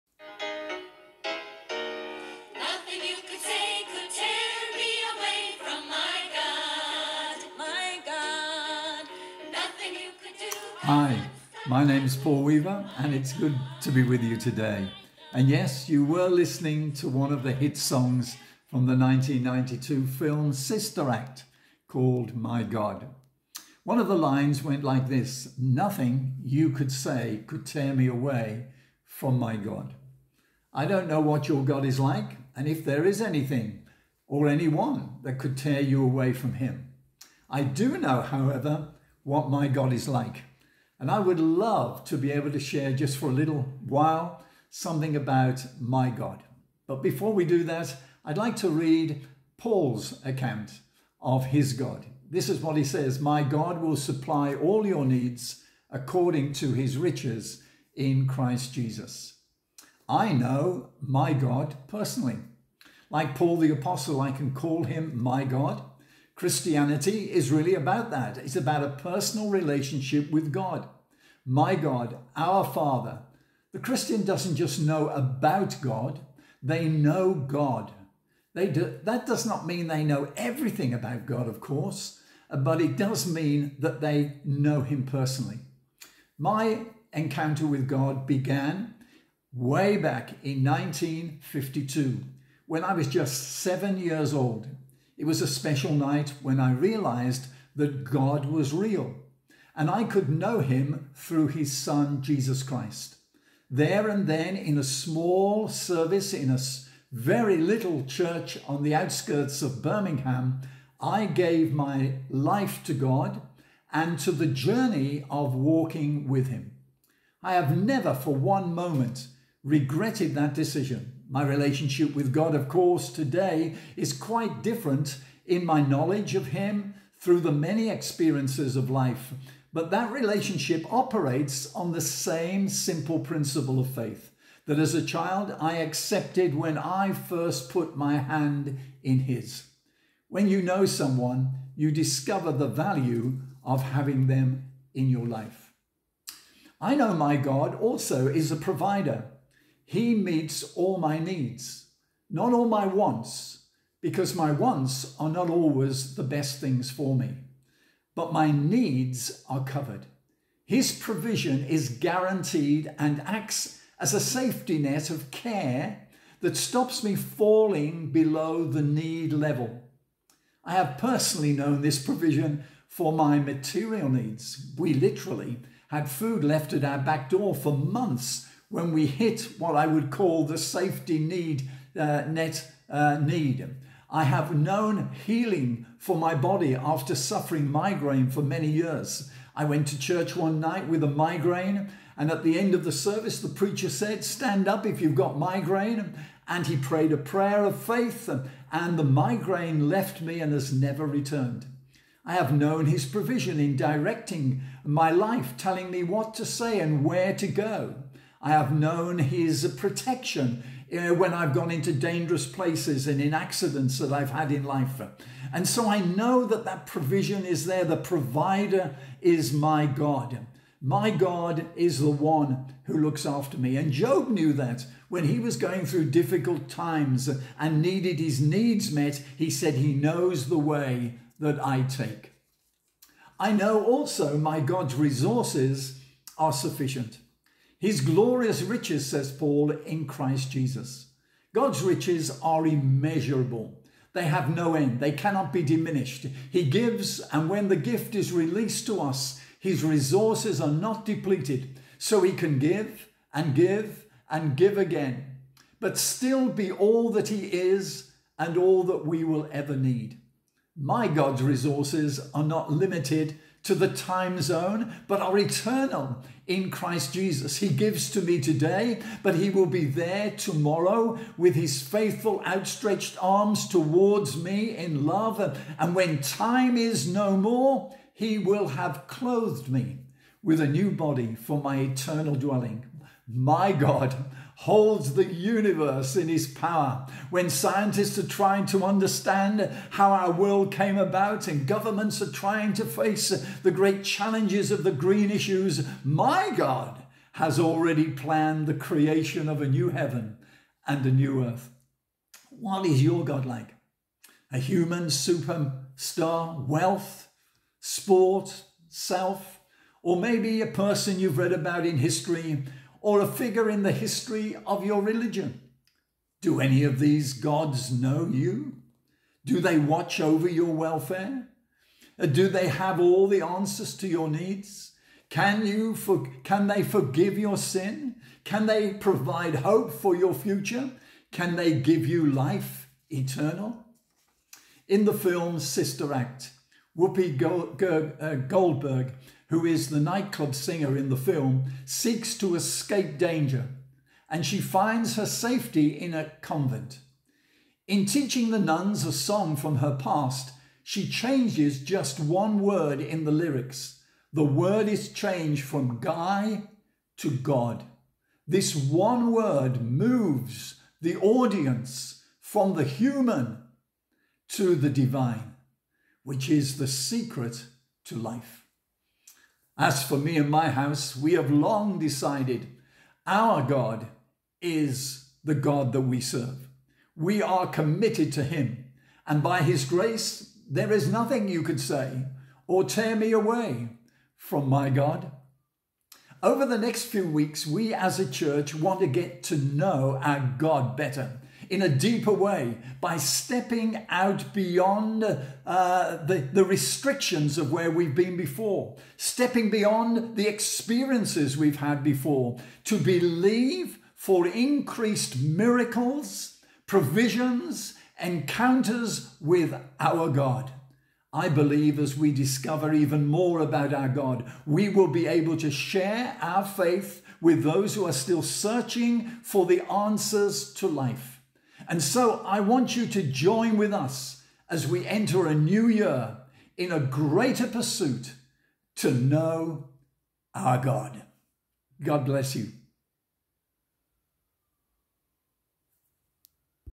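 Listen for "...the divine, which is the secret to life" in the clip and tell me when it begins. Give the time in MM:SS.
06:04.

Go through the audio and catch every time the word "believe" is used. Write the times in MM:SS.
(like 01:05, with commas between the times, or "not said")
06:42, 06:51.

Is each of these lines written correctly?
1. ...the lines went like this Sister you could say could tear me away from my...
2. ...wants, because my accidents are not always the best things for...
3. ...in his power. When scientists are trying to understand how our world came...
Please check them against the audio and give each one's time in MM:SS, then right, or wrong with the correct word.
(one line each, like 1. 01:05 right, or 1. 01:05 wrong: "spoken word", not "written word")
1. 00:24 wrong: "Nothing", not "Sister"
2. 02:32 wrong: "wants", not "accidents"
3. 04:46 right.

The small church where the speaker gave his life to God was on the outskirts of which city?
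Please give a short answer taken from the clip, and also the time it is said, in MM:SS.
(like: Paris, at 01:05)
Birmingham, at 01:49.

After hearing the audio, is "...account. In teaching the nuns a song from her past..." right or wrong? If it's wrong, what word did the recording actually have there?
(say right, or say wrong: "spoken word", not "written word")
wrong: "convent", not "account".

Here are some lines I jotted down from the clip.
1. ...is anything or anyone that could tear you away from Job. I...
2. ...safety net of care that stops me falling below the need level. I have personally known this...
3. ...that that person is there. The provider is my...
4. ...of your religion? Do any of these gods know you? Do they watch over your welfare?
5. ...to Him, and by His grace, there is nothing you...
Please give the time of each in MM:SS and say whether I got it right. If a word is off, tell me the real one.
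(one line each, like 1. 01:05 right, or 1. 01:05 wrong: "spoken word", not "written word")
1. 00:33 wrong: "Him", not "Job"
2. 02:44 right
3. 03:36 wrong: "provision", not "person"
4. 05:14 right
5. 06:18 right.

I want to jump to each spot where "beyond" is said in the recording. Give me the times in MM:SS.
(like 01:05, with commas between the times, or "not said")
06:34, 06:39.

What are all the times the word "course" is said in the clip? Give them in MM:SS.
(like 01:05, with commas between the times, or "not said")
01:21, 02:02.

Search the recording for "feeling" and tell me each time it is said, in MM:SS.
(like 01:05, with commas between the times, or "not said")
not said.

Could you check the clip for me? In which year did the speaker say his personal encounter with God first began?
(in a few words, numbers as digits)
1952.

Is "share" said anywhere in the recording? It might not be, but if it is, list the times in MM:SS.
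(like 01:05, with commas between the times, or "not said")
00:42, 06:55.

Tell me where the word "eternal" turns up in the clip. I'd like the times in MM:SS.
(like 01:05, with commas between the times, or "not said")
04:25, 04:41, 05:33.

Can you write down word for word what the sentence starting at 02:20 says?
When you know someone, you discover the value of having them in your life.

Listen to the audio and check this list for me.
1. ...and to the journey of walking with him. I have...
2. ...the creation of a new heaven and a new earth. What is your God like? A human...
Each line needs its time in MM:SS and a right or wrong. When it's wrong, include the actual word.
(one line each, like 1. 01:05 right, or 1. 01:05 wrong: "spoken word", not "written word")
1. 01:53 right
2. 04:58 right.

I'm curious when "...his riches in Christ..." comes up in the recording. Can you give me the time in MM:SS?
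00:56.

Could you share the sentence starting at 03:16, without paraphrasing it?
And he prayed a prayer of faith, and the migraine left me and has never returned.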